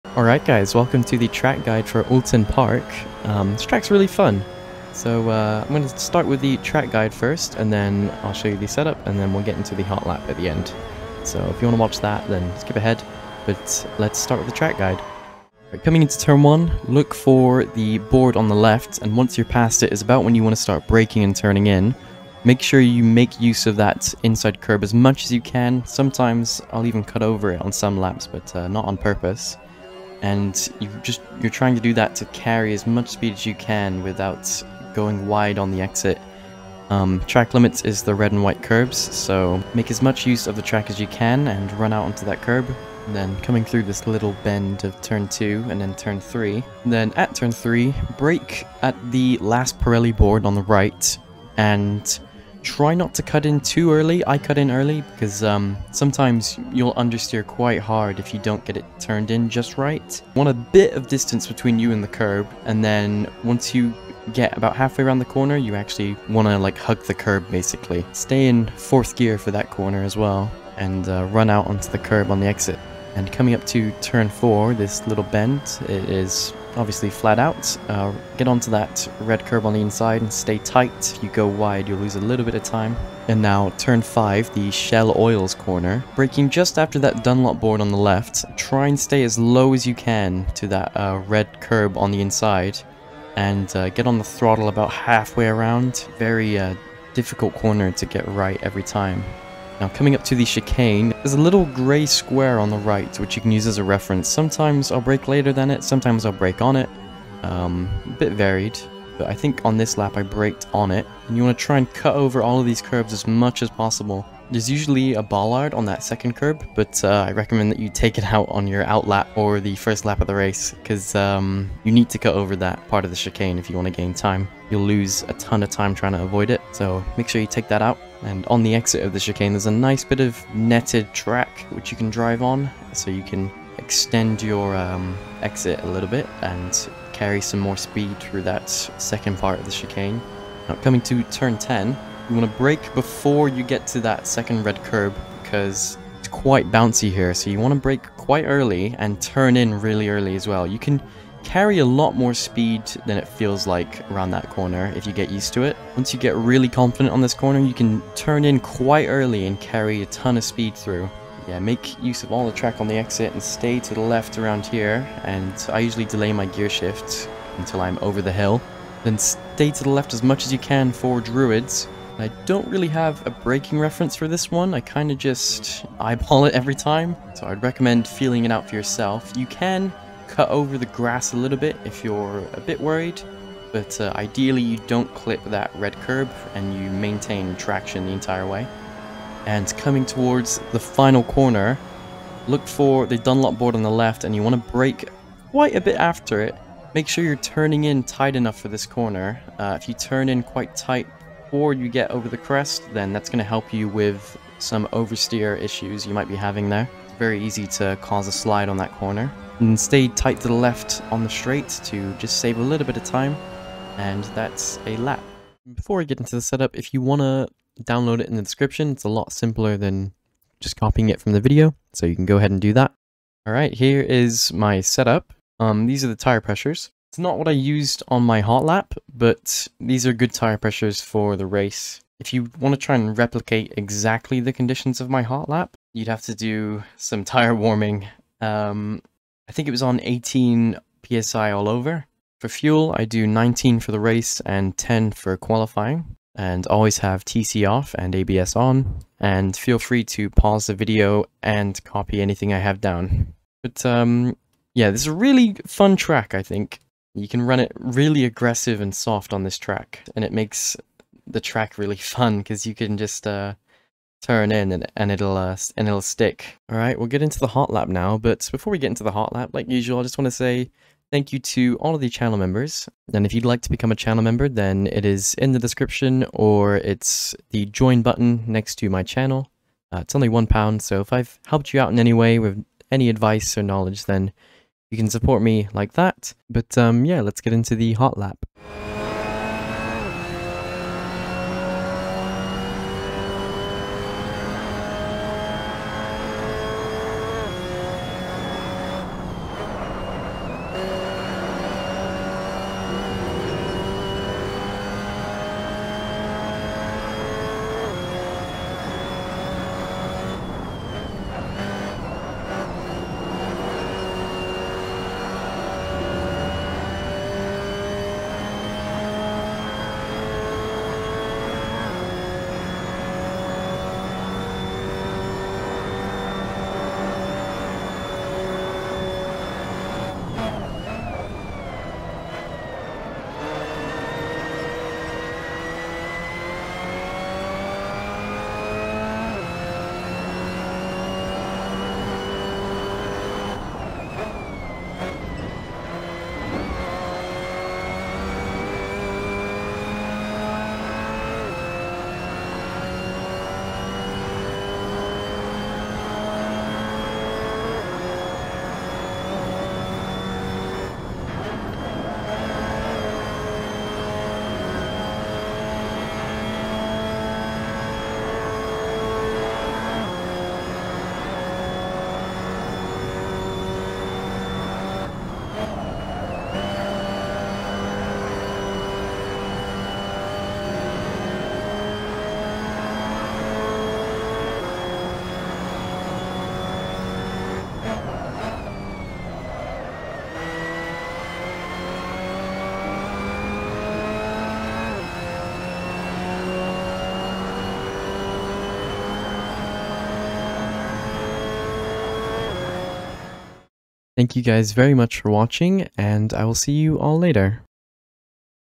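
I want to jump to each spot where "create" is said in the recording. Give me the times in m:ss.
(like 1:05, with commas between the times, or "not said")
not said.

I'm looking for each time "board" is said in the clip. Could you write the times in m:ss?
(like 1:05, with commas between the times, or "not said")
0:17, 0:50, 1:27, 3:13.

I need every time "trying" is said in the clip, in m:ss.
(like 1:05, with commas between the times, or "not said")
0:31, 2:05.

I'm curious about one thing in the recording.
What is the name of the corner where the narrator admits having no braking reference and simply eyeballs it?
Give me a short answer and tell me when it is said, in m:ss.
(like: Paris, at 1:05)
Druids, at 2:51.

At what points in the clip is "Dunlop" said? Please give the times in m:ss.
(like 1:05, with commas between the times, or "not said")
1:27, 3:13.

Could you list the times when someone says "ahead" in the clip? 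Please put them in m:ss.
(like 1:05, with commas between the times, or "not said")
0:12, 3:42.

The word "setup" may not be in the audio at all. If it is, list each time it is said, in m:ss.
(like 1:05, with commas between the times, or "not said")
0:08, 3:36, 3:44.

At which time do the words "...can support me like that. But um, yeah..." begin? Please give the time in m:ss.
4:44.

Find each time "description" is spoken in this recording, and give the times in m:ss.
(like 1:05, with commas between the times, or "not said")
3:38, 4:35.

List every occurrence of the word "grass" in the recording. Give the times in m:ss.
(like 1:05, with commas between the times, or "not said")
3:00.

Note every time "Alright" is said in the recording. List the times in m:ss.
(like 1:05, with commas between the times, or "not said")
0:00, 3:43.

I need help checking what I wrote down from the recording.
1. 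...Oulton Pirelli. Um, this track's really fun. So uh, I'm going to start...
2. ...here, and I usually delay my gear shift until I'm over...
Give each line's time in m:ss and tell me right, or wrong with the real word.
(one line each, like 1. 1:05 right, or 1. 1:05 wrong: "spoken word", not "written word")
1. 0:02 wrong: "Park", not "Pirelli"
2. 2:44 right.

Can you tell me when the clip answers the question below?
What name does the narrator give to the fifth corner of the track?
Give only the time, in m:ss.
1:24.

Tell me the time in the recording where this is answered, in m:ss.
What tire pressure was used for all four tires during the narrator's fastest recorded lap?
3:59.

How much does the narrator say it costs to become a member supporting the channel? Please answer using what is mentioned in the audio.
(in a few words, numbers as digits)
one pound.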